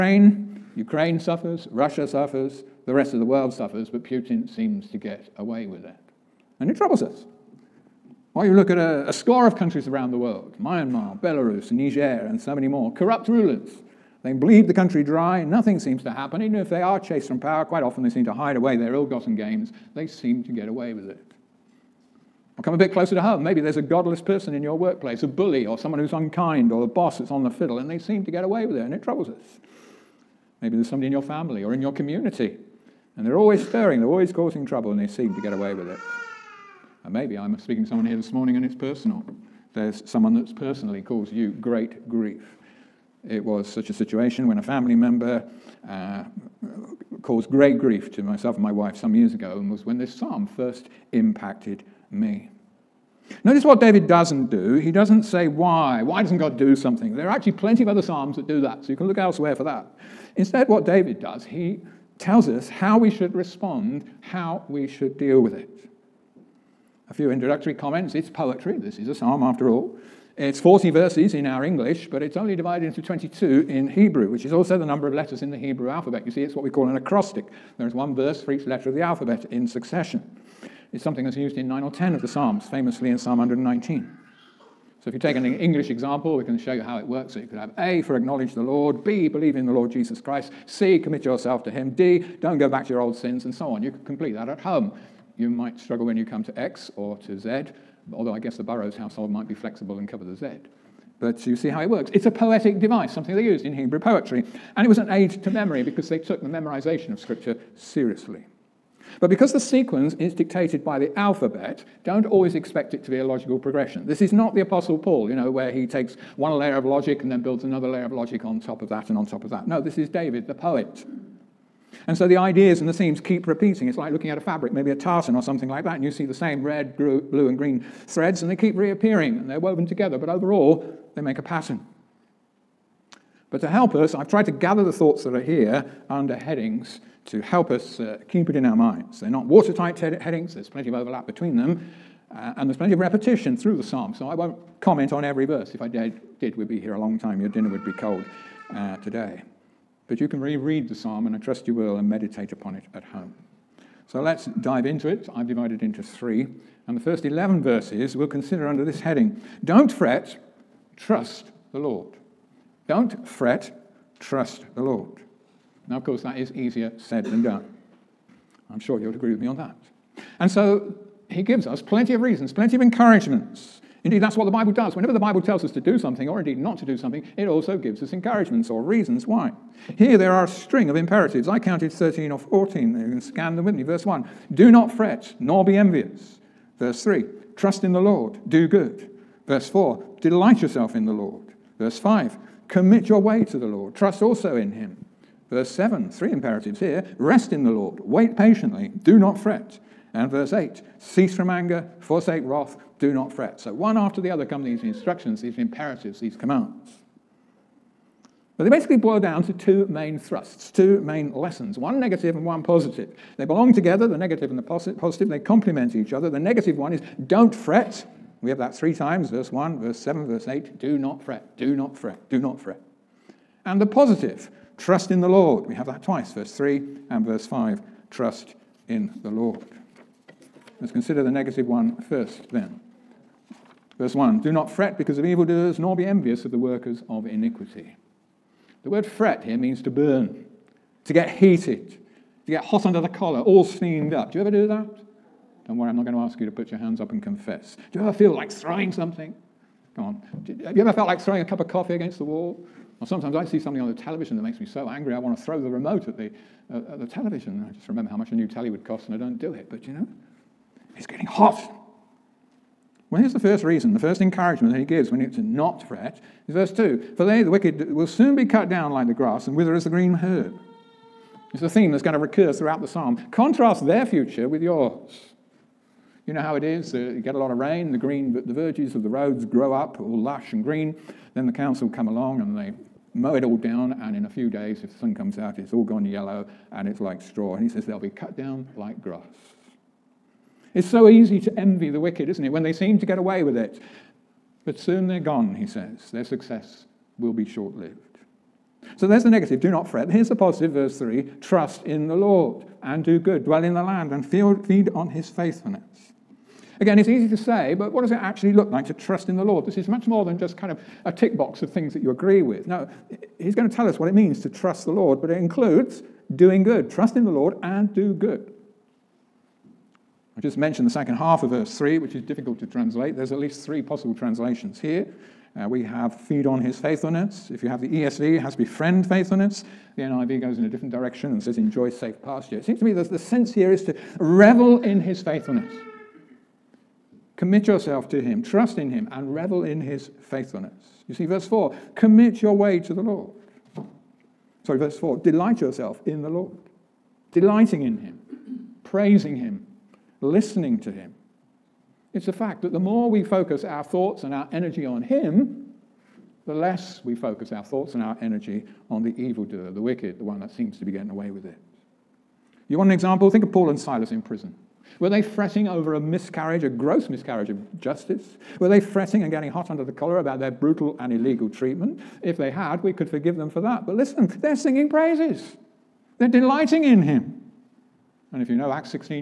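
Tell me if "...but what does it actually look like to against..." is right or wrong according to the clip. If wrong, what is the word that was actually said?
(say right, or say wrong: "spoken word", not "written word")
wrong: "trust", not "against".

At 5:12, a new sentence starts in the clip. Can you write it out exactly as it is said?
Now, he's going to tell us what it means to trust the Lord, but it includes doing good.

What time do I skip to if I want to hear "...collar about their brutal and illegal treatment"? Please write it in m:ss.
6:09.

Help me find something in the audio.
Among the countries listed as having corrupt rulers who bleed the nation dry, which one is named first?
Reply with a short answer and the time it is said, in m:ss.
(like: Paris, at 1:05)
Myanmar, at 0:10.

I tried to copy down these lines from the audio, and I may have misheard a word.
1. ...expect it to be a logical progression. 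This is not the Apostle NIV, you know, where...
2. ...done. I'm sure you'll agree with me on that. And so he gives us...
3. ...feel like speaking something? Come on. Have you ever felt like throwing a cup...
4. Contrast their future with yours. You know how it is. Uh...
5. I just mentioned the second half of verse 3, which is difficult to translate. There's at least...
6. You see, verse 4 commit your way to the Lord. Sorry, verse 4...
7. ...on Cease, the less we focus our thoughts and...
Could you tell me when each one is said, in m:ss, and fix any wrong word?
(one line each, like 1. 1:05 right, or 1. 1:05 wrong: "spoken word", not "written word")
1. 1:52 wrong: "Paul", not "NIV"
2. 2:47 right
3. 4:08 wrong: "throwing", not "speaking"
4. 4:33 right
5. 5:20 right
6. 5:41 right
7. 5:54 wrong: "Him", not "Cease".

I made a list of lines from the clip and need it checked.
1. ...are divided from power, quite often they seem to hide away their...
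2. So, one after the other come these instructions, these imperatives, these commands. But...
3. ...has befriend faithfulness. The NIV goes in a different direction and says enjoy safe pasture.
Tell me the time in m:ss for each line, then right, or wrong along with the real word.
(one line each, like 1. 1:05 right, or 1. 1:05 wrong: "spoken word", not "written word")
1. 0:16 wrong: "chased", not "divided"
2. 3:23 right
3. 5:28 right.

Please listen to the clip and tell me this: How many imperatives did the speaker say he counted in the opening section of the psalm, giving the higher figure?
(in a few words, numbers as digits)
14.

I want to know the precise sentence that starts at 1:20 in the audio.
It's something that's used in 9 or 10 of the Psalms, famously in Psalm 119.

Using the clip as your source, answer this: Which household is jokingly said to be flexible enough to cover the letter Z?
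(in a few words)
the Burroughs household.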